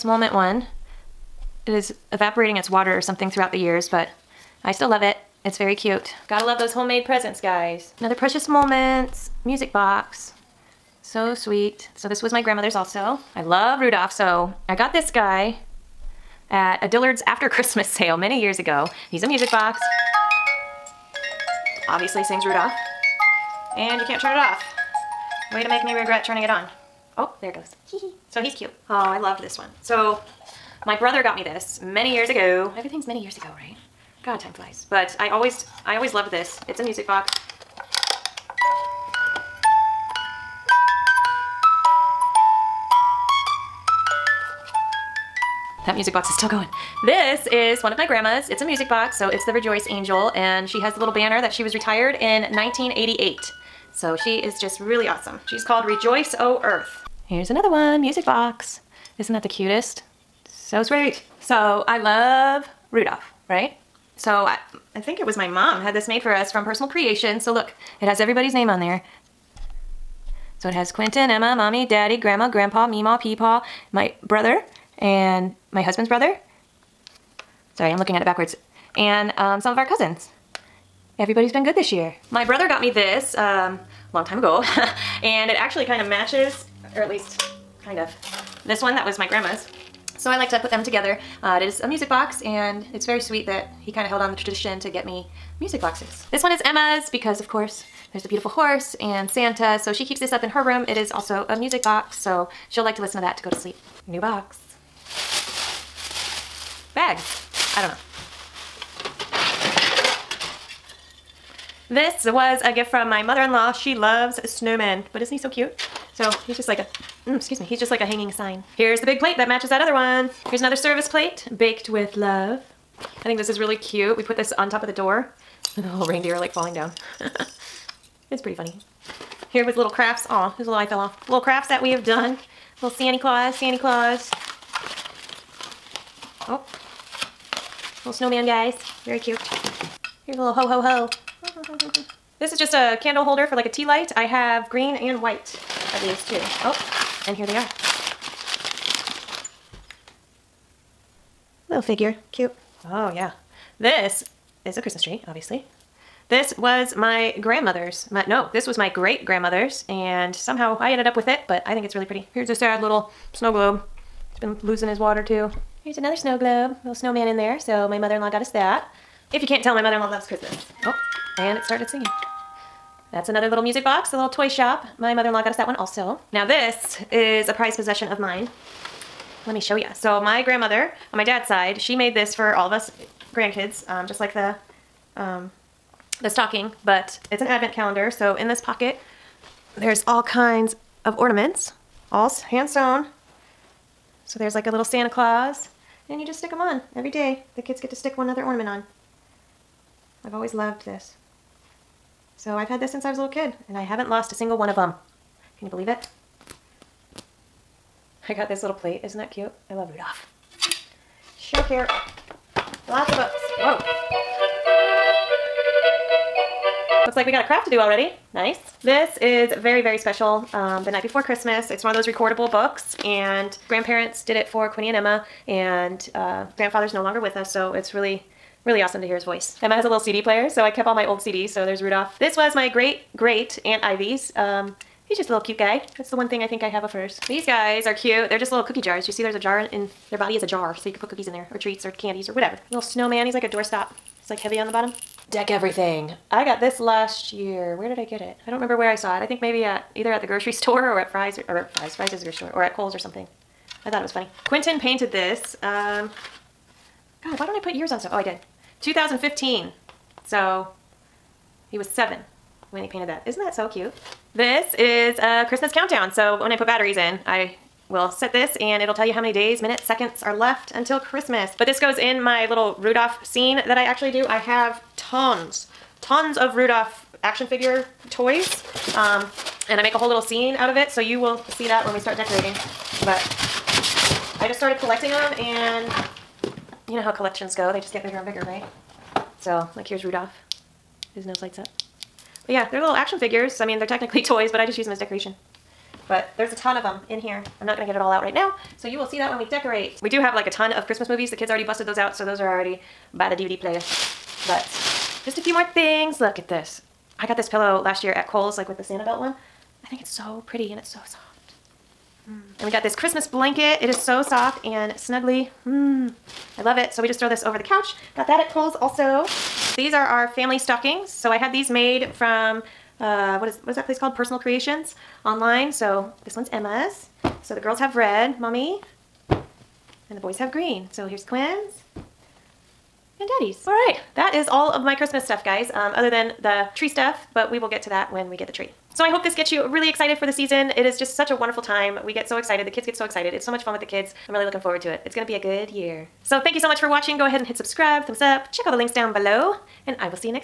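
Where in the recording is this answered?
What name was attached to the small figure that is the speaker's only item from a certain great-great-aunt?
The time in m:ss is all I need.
3:53.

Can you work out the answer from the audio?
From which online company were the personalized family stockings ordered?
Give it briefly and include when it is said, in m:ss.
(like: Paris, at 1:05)
Personal Creations, at 5:24.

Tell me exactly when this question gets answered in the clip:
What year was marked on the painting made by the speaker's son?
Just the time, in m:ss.
4:18.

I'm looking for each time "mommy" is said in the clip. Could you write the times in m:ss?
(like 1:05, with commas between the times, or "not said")
1:11, 5:28.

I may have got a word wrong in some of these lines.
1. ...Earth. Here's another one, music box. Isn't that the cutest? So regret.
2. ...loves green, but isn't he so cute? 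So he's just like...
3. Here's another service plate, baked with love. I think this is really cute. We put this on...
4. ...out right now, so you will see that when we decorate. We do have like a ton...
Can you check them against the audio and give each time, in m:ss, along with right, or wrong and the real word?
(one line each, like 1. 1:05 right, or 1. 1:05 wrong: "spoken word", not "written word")
1. 0:56 wrong: "sweet", not "regret"
2. 1:53 wrong: "snowmen", not "green"
3. 2:00 right
4. 4:58 right.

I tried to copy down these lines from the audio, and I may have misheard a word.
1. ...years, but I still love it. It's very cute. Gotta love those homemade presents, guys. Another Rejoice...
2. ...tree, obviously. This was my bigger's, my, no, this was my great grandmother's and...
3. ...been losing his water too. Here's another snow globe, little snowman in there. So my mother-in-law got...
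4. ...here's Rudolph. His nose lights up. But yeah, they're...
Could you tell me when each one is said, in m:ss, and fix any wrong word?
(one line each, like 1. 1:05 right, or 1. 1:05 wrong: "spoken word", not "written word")
1. 0:03 wrong: "Precious", not "Rejoice"
2. 2:35 wrong: "grandmother", not "bigger"
3. 2:44 right
4. 4:49 right.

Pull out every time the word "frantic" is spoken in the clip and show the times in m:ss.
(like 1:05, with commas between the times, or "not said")
not said.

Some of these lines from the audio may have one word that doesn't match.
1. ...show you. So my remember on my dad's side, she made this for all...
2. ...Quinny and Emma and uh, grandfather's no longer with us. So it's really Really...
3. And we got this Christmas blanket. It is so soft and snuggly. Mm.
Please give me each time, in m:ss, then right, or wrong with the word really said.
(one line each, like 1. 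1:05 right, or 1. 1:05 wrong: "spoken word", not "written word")
1. 2:59 wrong: "grandmother", not "remember"
2. 3:44 right
3. 5:12 right.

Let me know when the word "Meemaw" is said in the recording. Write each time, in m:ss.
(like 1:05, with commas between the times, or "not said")
1:12.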